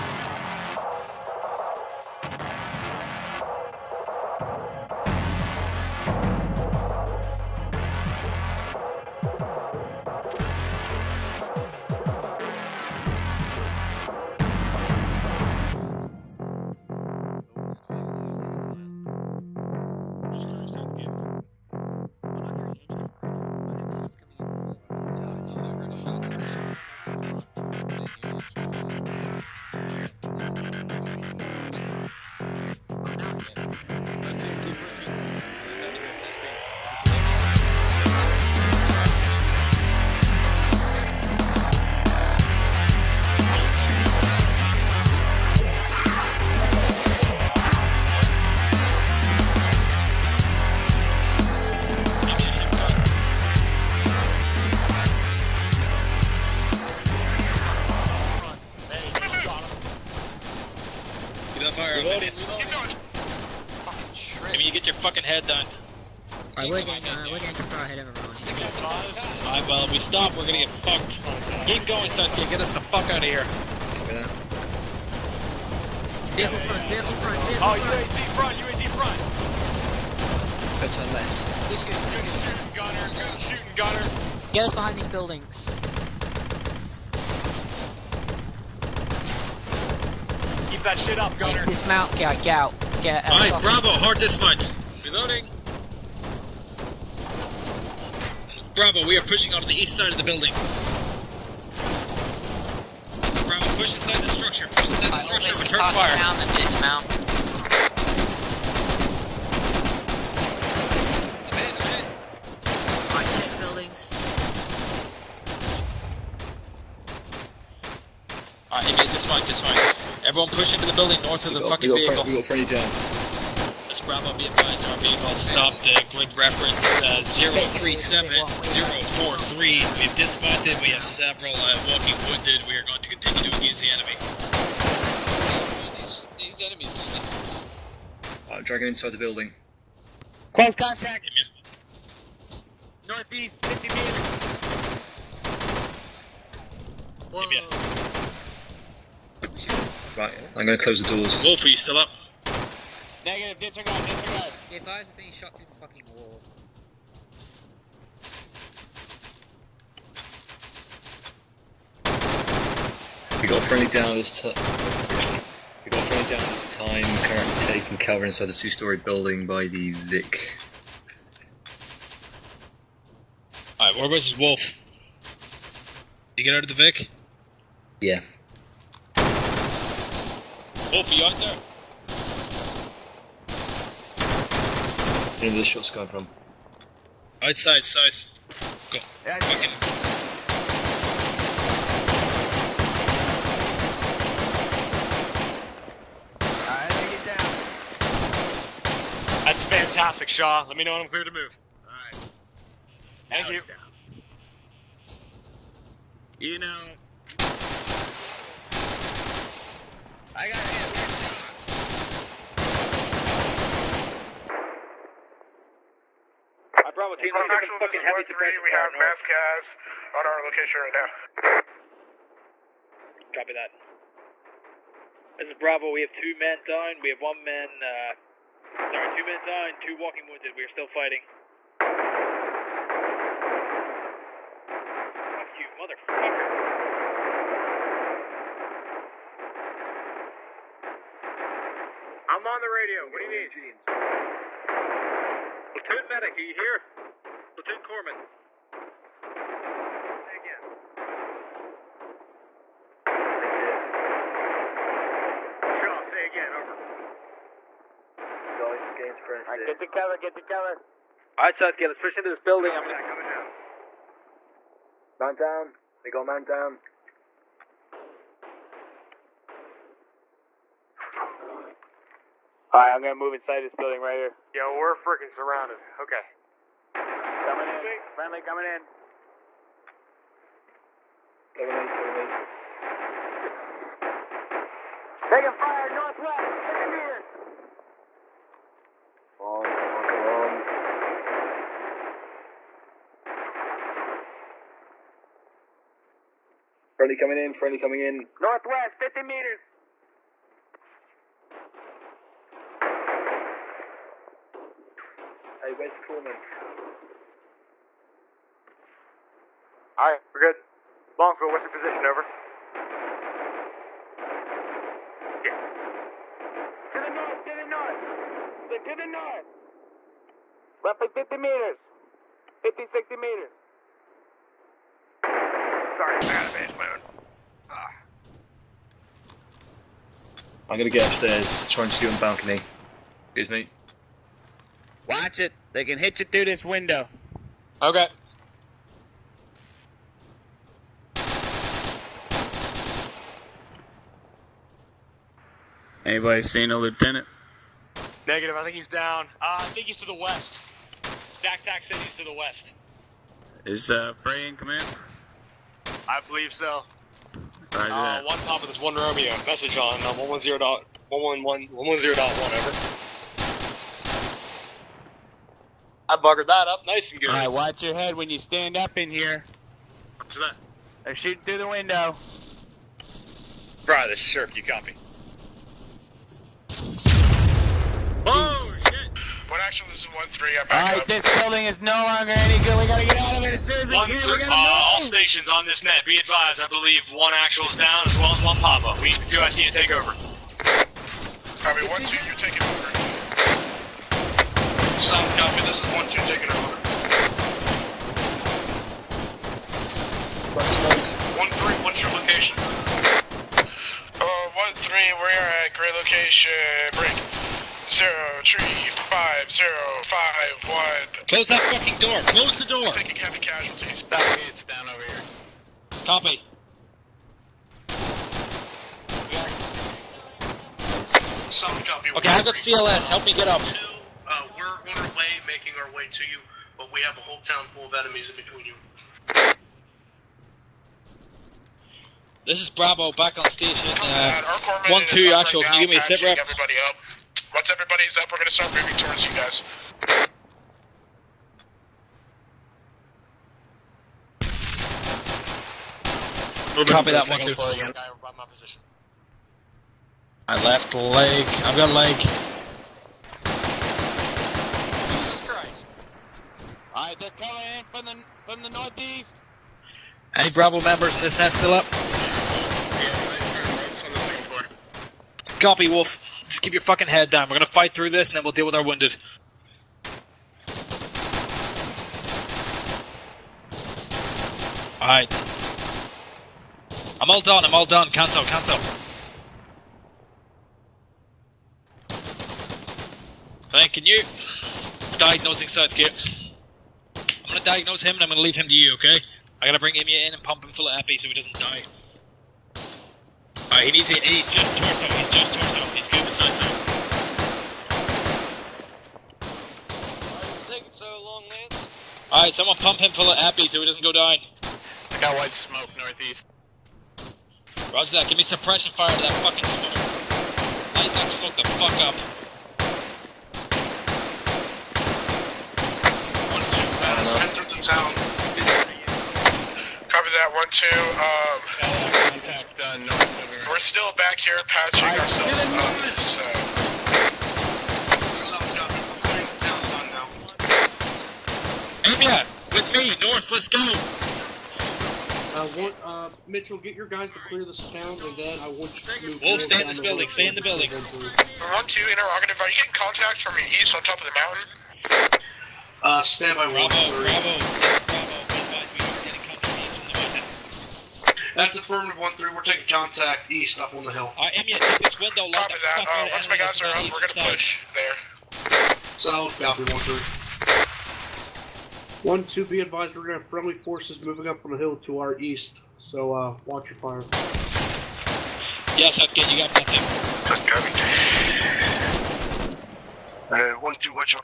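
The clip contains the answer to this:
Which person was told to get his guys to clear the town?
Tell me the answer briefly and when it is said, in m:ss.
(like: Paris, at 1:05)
Mitchell, at 8:56.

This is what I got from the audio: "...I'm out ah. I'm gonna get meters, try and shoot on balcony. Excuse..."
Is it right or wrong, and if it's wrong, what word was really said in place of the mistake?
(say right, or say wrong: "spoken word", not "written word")
wrong: "upstairs", not "meters".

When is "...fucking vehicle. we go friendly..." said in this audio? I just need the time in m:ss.
2:01.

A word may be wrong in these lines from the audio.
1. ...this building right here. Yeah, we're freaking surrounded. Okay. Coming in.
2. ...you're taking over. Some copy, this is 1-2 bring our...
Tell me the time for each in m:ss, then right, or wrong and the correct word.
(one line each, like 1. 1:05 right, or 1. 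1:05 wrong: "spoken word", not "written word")
1. 4:33 right
2. 6:32 wrong: "taking", not "bring".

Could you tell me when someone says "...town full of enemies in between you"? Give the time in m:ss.
7:07.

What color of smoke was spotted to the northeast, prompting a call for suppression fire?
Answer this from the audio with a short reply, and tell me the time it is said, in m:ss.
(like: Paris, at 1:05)
White, at 8:25.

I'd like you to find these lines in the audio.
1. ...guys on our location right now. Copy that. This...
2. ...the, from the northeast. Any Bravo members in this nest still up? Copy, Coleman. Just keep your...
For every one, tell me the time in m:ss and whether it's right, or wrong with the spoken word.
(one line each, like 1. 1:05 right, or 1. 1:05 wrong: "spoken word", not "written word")
1. 3:39 right
2. 7:38 wrong: "Wolf", not "Coleman".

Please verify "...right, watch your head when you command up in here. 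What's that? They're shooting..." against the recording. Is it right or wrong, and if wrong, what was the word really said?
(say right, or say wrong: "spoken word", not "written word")
wrong: "stand", not "command".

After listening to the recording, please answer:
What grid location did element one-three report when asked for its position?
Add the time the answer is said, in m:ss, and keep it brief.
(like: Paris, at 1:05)
035051, at 6:47.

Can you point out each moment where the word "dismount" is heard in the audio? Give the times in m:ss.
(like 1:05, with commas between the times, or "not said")
1:31, 1:46.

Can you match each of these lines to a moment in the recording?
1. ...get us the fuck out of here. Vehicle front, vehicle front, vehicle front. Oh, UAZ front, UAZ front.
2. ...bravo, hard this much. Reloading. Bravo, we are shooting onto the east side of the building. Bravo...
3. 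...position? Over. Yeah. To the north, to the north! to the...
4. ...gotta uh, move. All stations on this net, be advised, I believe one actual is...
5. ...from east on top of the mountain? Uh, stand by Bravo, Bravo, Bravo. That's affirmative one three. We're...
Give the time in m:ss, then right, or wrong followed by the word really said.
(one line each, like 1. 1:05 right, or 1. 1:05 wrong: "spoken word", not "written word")
1. 1:12 right
2. 1:33 wrong: "pushing", not "shooting"
3. 5:11 right
4. 6:24 right
5. 9:03 right.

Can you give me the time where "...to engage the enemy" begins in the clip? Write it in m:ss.
2:13.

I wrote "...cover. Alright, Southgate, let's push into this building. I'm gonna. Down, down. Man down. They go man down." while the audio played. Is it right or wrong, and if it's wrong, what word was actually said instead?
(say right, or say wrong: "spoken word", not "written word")
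right.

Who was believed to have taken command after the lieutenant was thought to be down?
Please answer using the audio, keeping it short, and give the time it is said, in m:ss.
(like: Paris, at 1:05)
Frey, at 5:54.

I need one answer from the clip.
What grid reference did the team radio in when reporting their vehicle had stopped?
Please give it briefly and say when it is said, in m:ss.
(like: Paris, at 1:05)
037043, at 2:07.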